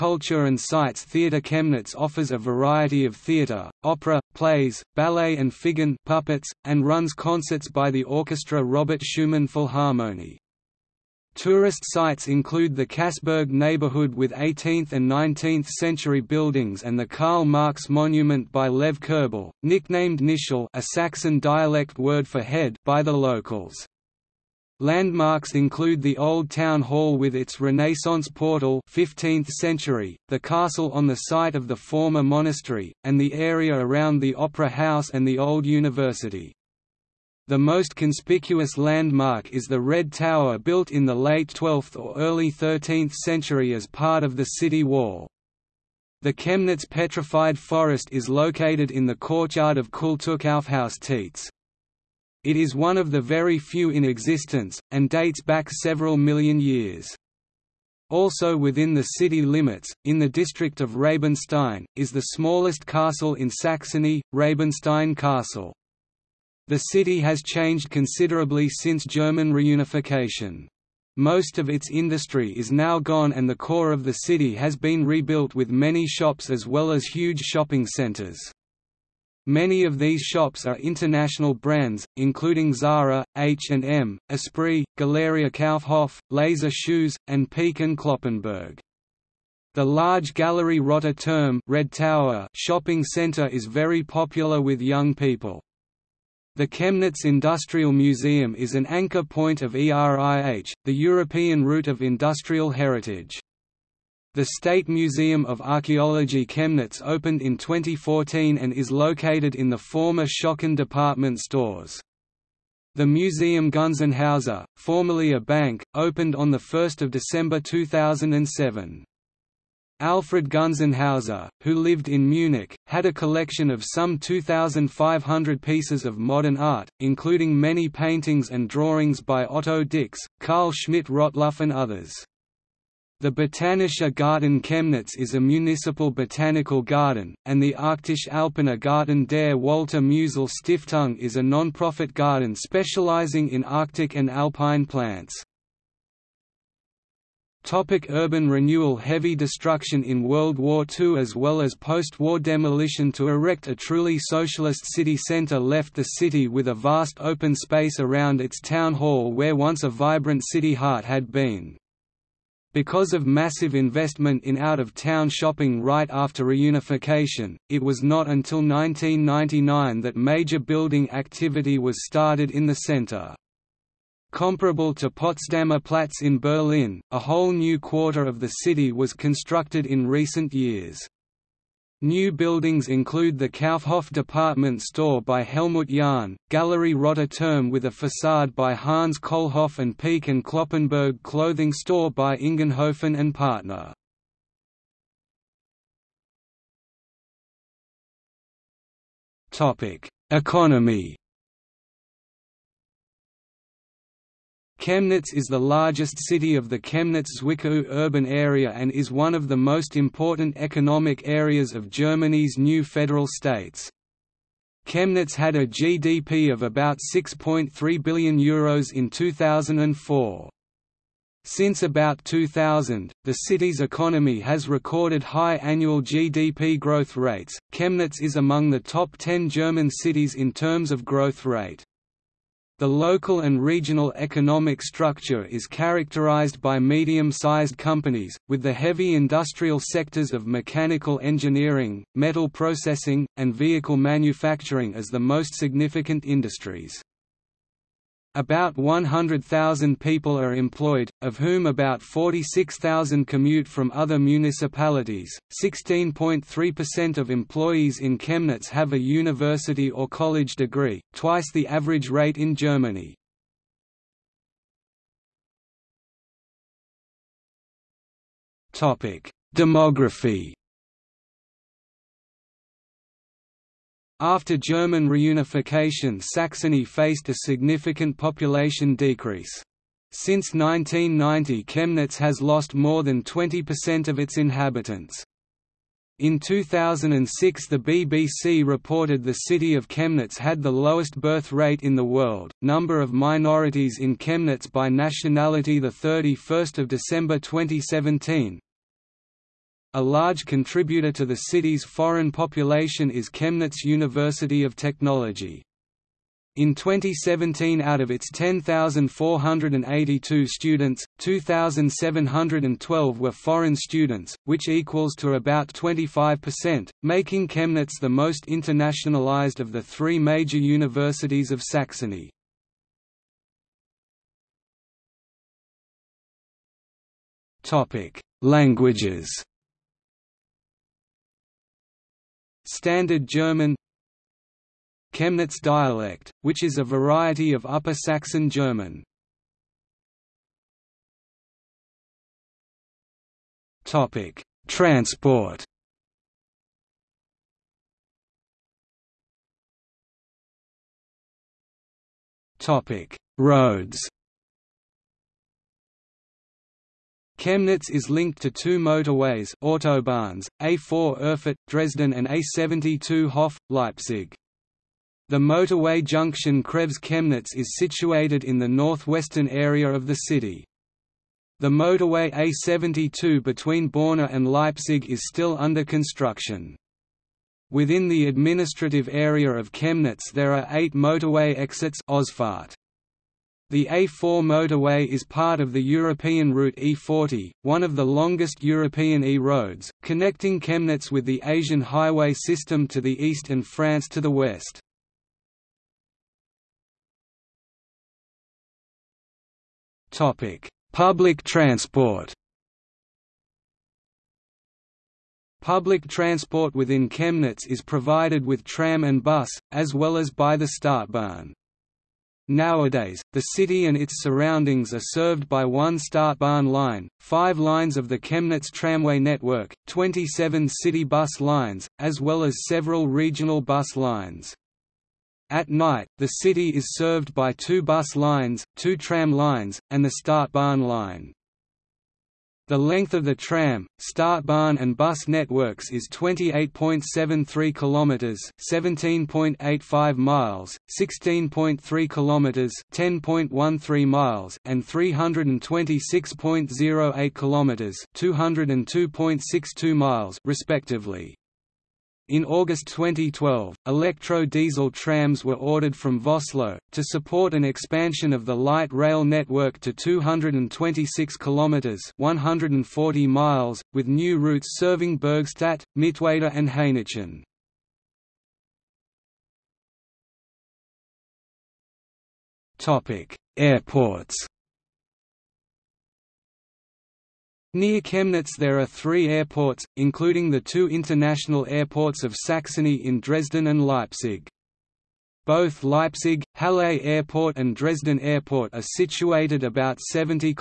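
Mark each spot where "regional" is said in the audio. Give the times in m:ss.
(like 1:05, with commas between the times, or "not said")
3:53, 7:03.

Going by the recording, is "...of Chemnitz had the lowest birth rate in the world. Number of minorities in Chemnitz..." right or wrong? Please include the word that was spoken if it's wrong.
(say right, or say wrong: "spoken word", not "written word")
right.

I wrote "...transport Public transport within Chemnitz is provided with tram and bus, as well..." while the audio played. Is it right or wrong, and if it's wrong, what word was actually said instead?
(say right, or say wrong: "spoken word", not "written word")
right.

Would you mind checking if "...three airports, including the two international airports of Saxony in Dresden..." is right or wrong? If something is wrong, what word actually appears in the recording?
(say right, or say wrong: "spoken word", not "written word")
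right.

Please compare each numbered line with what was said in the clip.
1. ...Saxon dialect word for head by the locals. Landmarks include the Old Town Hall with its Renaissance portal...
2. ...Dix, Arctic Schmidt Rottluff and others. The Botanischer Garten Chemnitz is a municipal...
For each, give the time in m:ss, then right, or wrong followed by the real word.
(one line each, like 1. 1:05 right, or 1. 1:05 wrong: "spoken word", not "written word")
1. 0:20 right
2. 2:09 wrong: "Carl", not "Arctic".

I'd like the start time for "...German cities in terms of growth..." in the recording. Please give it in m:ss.
3:49.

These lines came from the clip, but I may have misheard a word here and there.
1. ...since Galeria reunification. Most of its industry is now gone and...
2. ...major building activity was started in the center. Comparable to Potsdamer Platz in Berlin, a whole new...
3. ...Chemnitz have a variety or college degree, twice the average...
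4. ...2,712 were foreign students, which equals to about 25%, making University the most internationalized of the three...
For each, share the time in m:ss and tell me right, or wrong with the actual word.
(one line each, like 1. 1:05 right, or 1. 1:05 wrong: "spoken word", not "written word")
1. 1:08 wrong: "German", not "Galeria"
2. 2:50 right
3. 4:18 wrong: "university", not "variety"
4. 5:11 wrong: "Chemnitz", not "University".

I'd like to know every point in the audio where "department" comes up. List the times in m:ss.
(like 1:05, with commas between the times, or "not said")
1:50, 3:04.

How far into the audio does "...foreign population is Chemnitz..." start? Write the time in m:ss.
5:01.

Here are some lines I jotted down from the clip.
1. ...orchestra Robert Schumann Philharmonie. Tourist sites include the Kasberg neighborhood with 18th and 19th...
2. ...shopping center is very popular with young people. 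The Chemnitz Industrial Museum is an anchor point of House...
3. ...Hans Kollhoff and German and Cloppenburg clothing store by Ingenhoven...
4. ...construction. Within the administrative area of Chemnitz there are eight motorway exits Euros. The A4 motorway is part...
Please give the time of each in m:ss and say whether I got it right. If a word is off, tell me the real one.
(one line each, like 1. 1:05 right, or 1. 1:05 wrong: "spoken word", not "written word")
1. 0:08 right
2. 1:32 wrong: "ERIH", not "House"
3. 3:08 wrong: "Peek", not "German"
4. 6:15 wrong: "Ausfahrt", not "Euros".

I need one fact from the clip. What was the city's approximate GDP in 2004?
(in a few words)
€6.3 billion.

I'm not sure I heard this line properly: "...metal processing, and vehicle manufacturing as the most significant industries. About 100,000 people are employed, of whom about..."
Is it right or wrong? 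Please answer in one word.
right.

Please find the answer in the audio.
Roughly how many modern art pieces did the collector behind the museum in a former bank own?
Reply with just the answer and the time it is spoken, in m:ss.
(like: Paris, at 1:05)
2,500, at 2:04.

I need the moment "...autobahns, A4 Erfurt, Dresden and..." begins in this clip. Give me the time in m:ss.
5:59.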